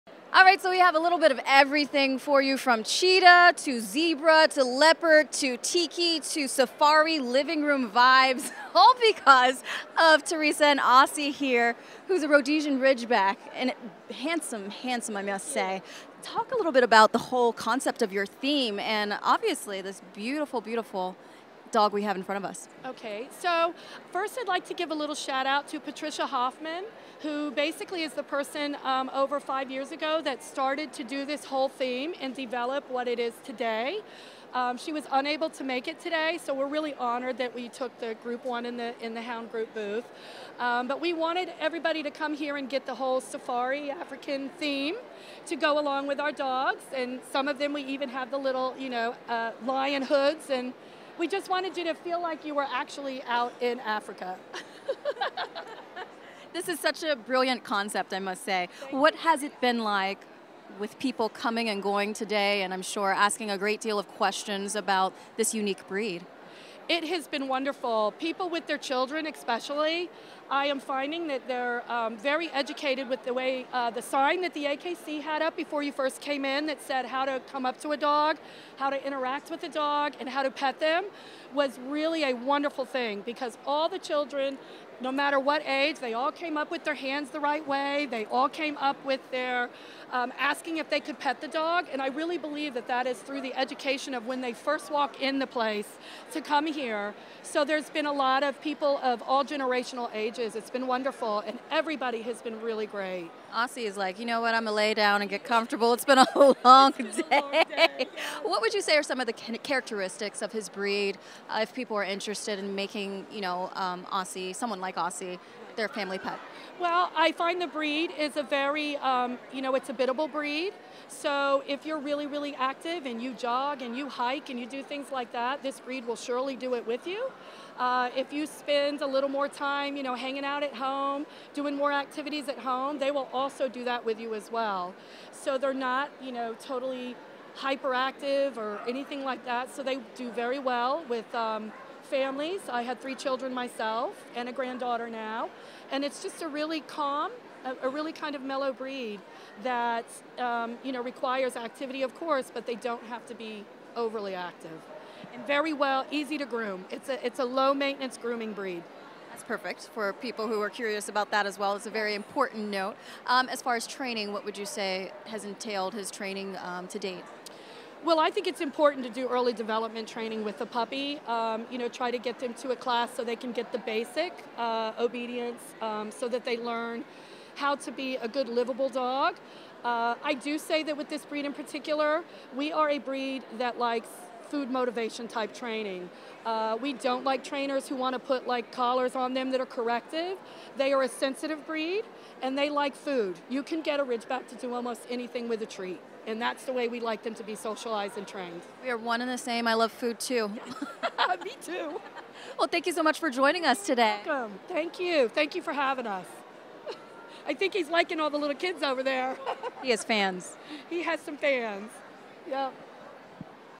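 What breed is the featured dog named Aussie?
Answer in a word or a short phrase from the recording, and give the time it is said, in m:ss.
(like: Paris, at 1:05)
Rhodesian Ridgeback, at 0:12.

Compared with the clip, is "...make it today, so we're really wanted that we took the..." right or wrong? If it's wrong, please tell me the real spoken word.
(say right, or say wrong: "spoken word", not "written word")
wrong: "honored", not "wanted".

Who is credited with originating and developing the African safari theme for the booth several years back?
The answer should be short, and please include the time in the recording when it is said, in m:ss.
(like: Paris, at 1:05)
Patricia Hoffman, at 0:25.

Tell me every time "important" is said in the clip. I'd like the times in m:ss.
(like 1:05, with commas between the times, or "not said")
2:42, 2:48.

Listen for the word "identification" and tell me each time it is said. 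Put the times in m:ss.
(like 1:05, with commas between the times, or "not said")
not said.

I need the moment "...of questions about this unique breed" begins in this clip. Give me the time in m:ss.
1:03.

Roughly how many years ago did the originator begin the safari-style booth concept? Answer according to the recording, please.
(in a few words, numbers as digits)
5.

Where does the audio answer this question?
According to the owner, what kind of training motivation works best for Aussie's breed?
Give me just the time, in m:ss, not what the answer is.
3:04.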